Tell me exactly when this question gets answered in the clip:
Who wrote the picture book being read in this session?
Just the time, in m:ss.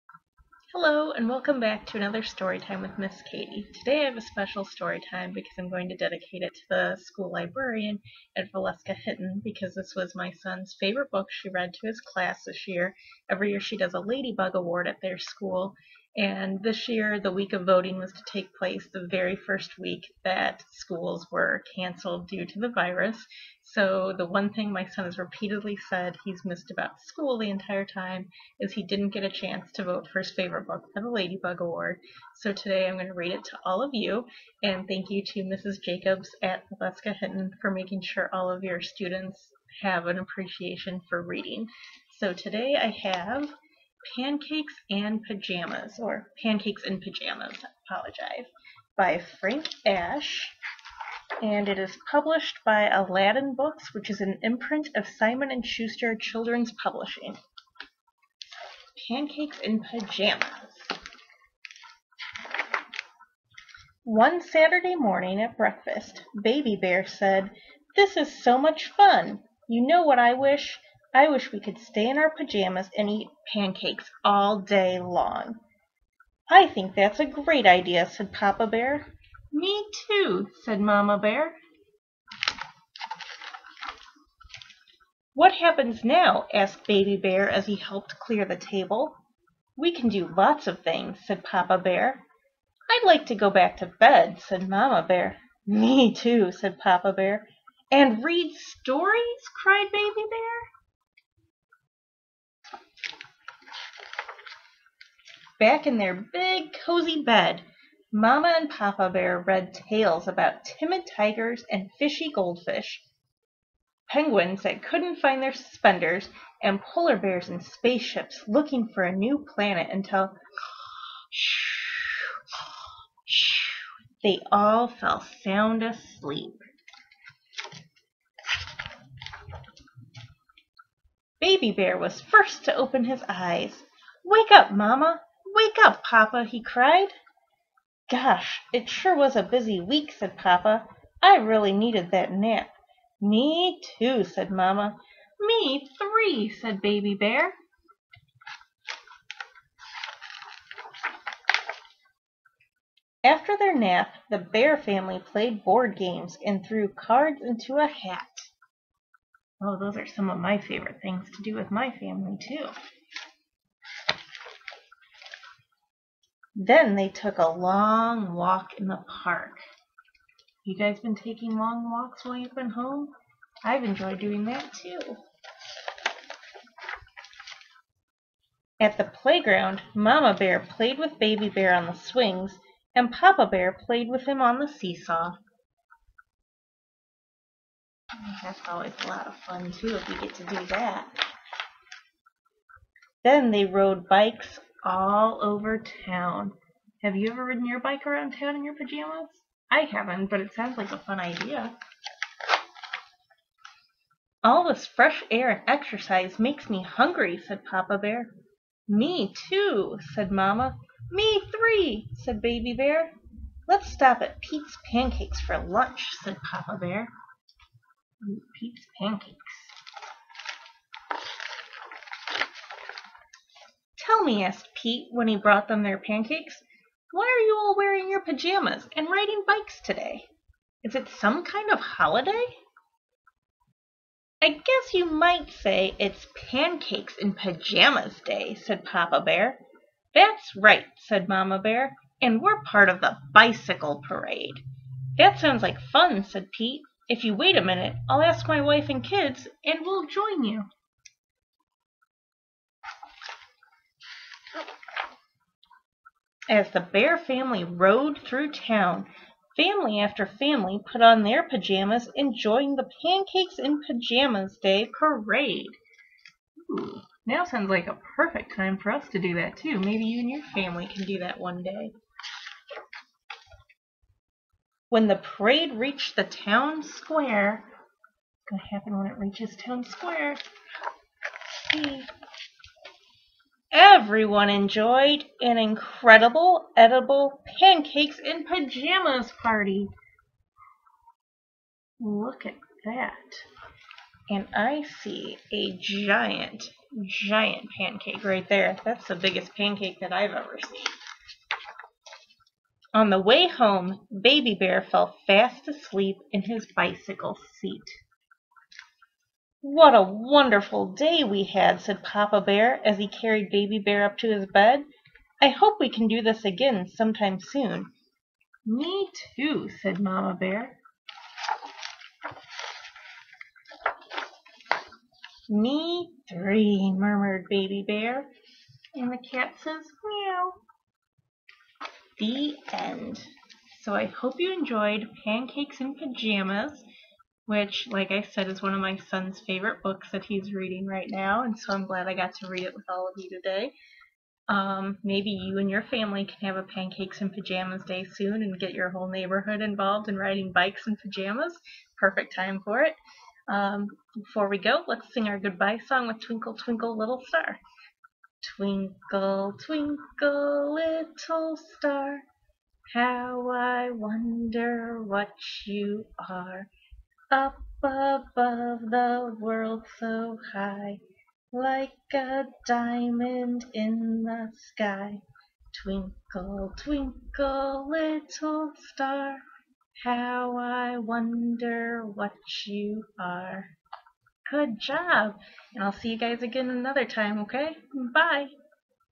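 0:49.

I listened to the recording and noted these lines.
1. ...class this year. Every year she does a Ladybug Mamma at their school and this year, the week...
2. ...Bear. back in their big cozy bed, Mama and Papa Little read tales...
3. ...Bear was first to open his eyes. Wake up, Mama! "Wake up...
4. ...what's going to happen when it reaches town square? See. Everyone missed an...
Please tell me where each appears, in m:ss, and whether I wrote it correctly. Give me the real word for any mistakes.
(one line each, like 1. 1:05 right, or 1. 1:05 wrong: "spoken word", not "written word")
1. 0:11 wrong: "Award", not "Mamma"
2. 1:40 wrong: "Bear", not "Little"
3. 2:11 right
4. 4:37 wrong: "enjoyed", not "missed".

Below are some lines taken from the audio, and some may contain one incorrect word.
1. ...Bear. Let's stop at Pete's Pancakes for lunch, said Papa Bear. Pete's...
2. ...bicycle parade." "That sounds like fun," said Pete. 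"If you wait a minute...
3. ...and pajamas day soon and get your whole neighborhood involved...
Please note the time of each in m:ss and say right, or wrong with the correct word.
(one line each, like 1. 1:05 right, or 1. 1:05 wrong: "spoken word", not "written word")
1. 3:32 right
2. 4:03 right
3. 5:47 right.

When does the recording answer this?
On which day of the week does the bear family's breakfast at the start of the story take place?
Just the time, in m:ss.
1:04.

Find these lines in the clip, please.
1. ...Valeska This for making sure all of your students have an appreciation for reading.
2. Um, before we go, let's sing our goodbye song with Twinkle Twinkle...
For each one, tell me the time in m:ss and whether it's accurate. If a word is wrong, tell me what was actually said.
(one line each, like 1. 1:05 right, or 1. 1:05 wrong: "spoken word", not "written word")
1. 0:36 wrong: "Hinton", not "This"
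2. 5:53 right.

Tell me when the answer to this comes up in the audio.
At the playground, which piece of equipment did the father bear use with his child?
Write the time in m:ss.
3:04.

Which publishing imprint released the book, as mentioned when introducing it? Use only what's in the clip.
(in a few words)
Aladdin Books.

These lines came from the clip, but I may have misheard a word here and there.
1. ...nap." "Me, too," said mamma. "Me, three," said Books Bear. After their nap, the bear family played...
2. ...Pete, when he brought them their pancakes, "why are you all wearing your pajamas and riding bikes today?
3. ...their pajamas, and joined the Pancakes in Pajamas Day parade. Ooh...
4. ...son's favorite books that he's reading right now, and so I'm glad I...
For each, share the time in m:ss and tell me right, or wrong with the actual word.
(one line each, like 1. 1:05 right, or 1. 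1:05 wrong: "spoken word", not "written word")
1. 2:22 wrong: "Baby", not "Books"
2. 3:44 right
3. 4:21 right
4. 5:38 right.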